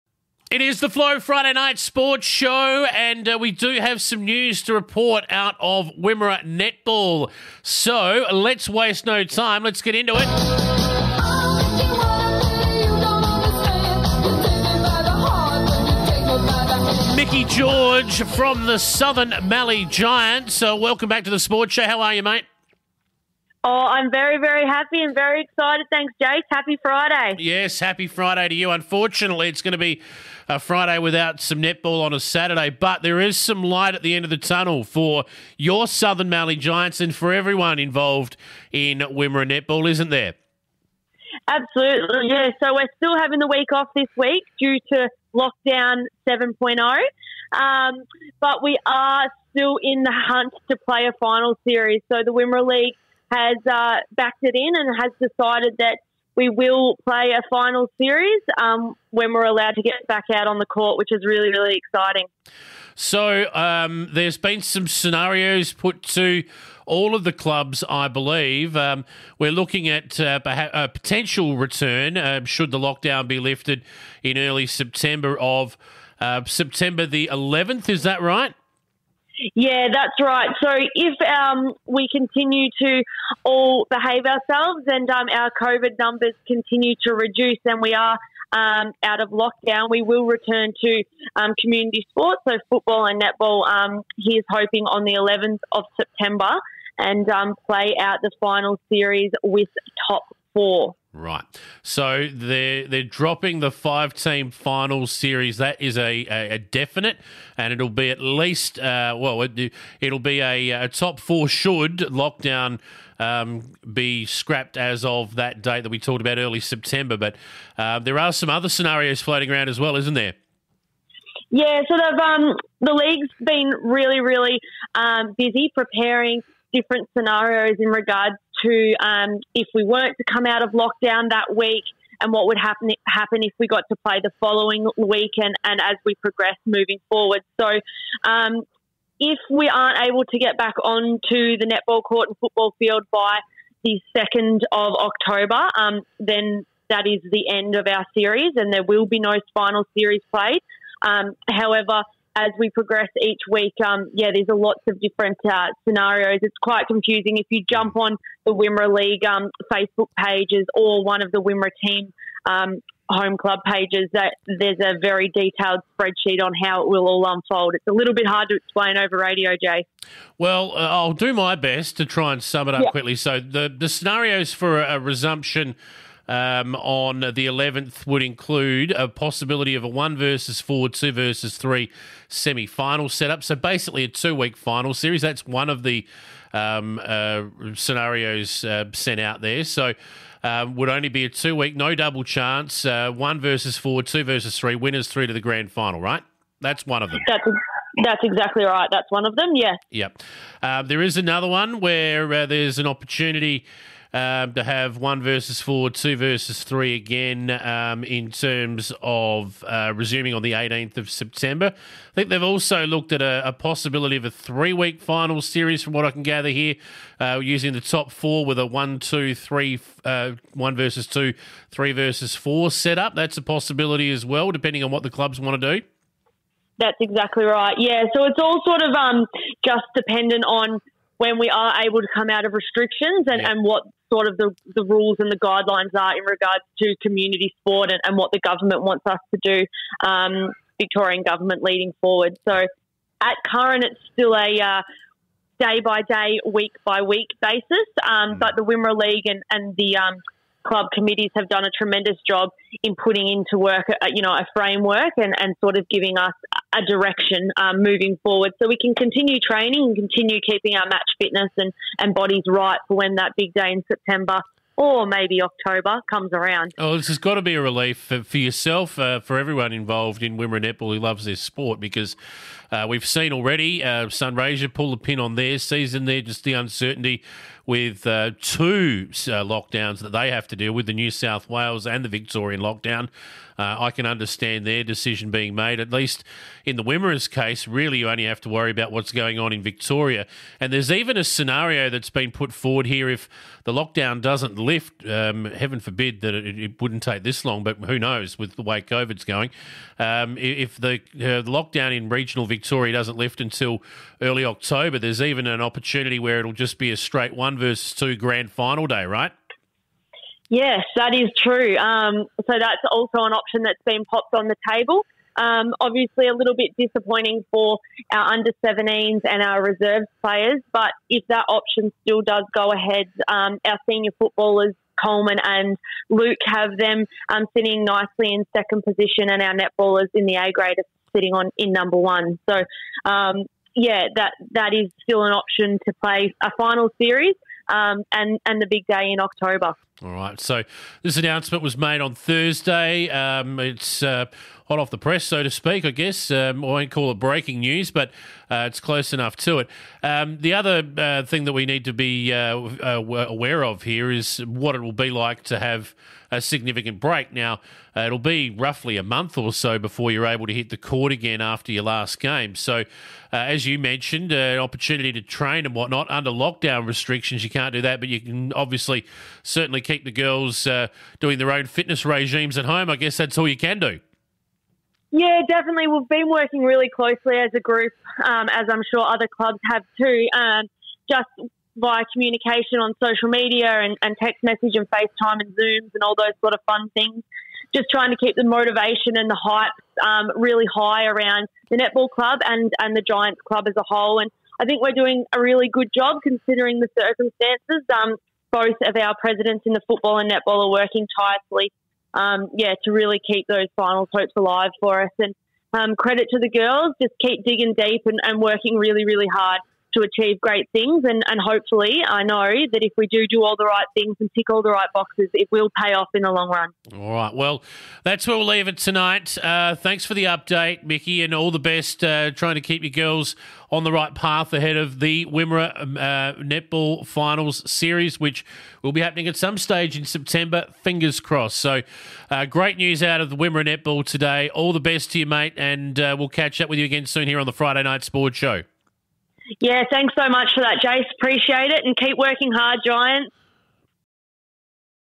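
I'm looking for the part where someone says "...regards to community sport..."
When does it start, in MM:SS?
03:56.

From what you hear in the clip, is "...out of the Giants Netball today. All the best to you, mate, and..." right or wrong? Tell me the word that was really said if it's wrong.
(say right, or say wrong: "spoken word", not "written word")
wrong: "Wimmera", not "Giants".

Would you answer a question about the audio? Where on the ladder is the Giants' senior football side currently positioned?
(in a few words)
second.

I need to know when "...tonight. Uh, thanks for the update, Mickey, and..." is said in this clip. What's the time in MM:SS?
06:58.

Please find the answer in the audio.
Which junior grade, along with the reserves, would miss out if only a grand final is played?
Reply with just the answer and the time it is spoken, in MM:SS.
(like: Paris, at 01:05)
under 17s, at 05:18.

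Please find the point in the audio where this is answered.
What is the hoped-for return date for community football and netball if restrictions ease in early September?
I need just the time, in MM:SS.
01:35.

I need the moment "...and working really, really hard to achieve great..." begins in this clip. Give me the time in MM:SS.
06:48.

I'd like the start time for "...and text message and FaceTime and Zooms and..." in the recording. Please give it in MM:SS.
06:24.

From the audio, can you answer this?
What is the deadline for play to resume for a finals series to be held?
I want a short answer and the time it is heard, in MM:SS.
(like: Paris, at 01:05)
2nd of October, at 02:24.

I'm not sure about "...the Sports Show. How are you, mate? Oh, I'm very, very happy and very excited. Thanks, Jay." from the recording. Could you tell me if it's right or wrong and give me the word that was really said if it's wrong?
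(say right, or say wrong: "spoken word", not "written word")
wrong: "Jace", not "Jay".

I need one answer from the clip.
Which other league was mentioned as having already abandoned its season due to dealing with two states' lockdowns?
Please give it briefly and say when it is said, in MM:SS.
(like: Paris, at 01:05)
Sunraysia, at 04:34.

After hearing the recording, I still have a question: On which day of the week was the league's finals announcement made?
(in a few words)
Thursday.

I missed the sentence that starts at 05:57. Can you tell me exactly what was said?
Now, uh, it'll be roughly a month or so before you're able to hit the court again after your last game.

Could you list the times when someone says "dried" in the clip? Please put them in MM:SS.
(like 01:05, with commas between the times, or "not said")
not said.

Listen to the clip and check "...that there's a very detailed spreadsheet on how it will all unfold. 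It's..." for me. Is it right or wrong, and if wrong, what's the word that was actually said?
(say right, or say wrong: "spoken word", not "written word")
right.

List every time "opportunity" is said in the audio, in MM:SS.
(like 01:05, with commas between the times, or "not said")
03:22, 05:05, 06:04.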